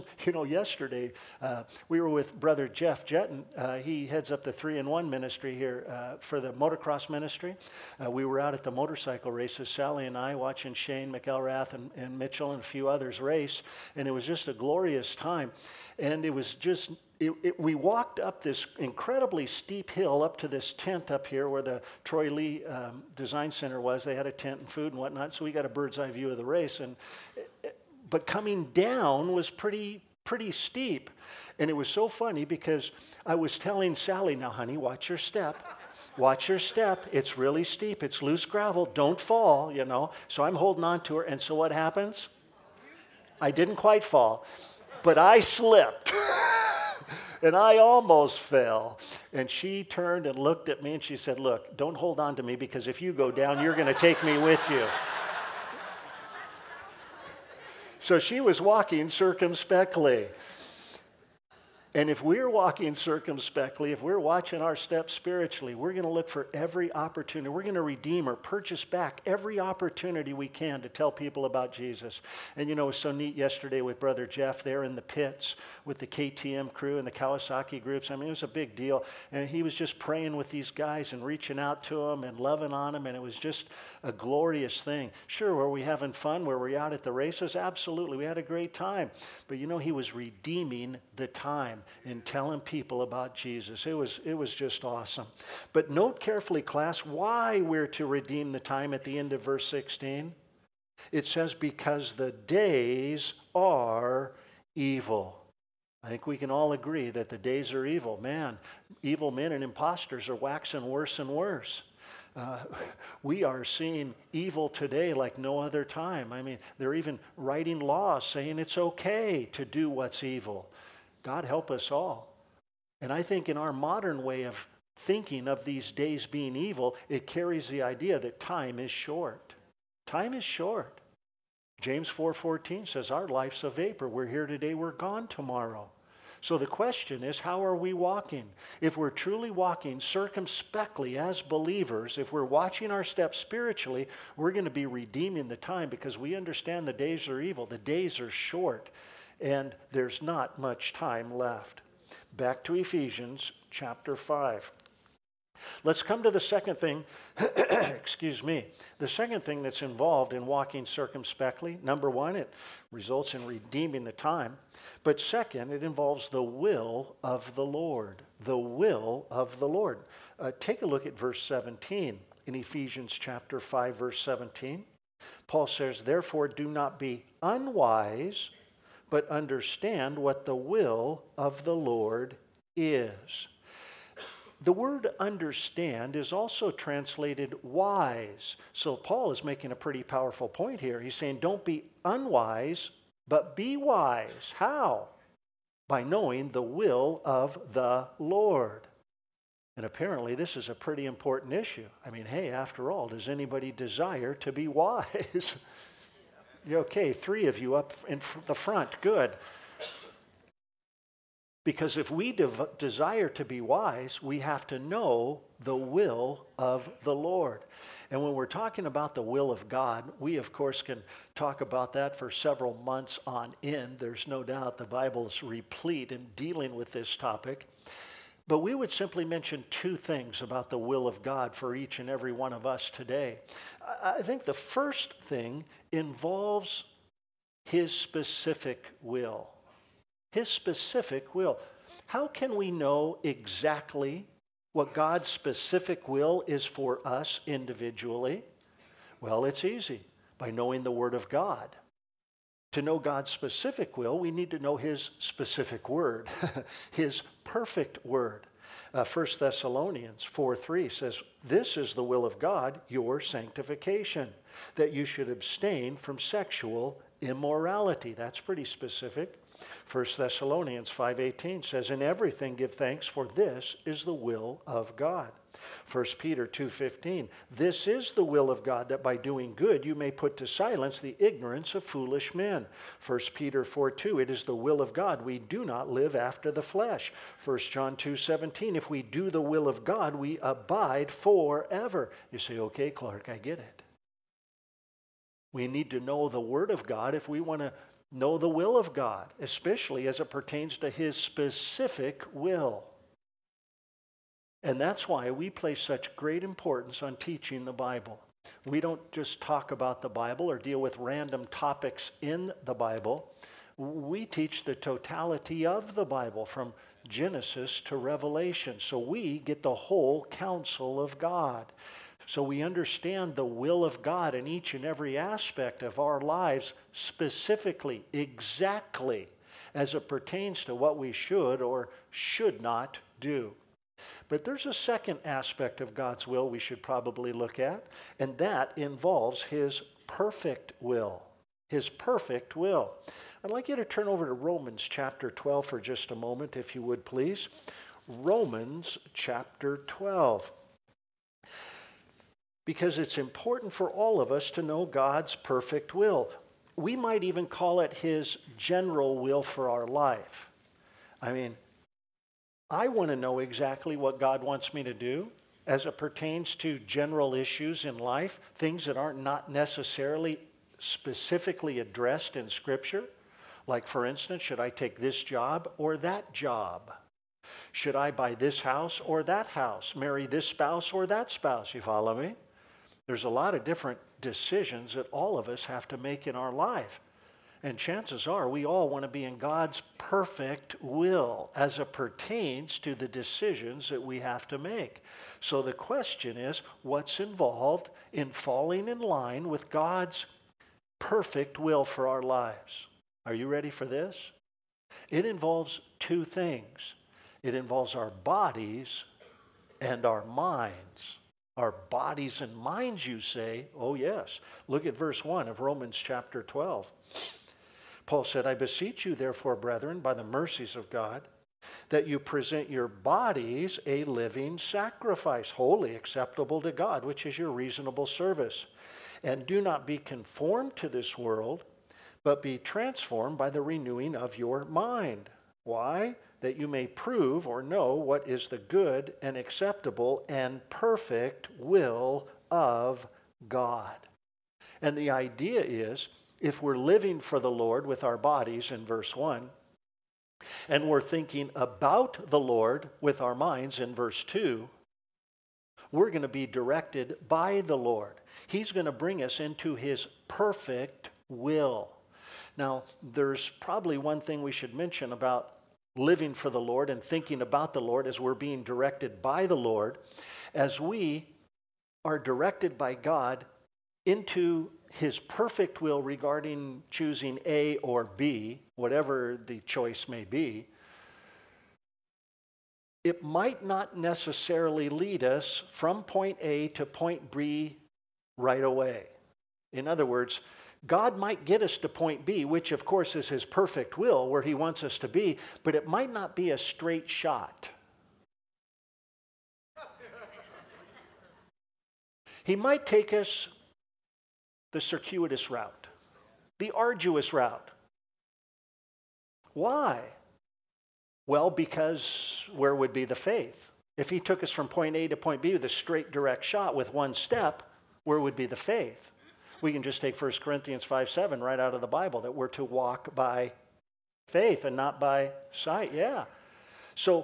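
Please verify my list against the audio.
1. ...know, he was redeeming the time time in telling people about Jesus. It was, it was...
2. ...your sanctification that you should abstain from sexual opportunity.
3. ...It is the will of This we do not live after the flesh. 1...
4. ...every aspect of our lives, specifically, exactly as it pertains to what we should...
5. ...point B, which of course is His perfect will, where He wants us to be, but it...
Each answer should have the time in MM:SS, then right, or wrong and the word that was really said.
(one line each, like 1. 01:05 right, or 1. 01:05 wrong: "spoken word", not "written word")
1. 01:29 right
2. 04:22 wrong: "immorality", not "opportunity"
3. 04:44 wrong: "God", not "This"
4. 05:24 right
5. 08:11 right.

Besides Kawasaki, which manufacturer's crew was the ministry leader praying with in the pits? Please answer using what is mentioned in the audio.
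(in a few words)
KTM.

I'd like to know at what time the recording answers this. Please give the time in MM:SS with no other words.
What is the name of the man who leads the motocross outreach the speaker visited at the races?
00:02.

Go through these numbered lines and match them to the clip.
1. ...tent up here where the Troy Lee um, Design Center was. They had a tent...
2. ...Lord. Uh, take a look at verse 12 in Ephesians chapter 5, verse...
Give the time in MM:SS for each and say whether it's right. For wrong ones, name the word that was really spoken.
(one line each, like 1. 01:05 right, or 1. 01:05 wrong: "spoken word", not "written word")
1. 00:20 right
2. 02:49 wrong: "17", not "12".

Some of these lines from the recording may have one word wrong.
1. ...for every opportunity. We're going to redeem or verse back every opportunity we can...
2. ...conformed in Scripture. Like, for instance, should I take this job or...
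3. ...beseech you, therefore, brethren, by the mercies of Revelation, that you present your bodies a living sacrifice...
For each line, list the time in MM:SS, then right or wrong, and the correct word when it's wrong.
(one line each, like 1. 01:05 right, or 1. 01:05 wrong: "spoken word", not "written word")
1. 01:06 wrong: "purchase", not "verse"
2. 06:11 wrong: "addressed", not "conformed"
3. 06:58 wrong: "God", not "Revelation".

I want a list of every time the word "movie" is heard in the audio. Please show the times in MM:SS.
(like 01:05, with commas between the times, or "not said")
not said.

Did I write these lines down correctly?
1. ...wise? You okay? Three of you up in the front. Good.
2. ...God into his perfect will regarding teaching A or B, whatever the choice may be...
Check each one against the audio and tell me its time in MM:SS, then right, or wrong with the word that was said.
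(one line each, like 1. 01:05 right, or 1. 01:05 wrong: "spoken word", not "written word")
1. 03:24 right
2. 07:52 wrong: "choosing", not "teaching".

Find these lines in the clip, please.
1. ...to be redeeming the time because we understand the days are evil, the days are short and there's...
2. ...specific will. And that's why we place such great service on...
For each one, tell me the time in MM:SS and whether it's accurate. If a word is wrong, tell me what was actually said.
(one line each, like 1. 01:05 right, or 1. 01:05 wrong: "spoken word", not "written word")
1. 02:24 right
2. 05:01 wrong: "importance", not "service".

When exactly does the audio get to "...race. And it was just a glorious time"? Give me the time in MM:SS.
00:13.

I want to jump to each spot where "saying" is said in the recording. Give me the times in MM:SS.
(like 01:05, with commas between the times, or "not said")
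01:58, 03:11.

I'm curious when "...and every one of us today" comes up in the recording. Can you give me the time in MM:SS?
03:51.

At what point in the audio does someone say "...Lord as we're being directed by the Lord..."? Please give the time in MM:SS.
07:47.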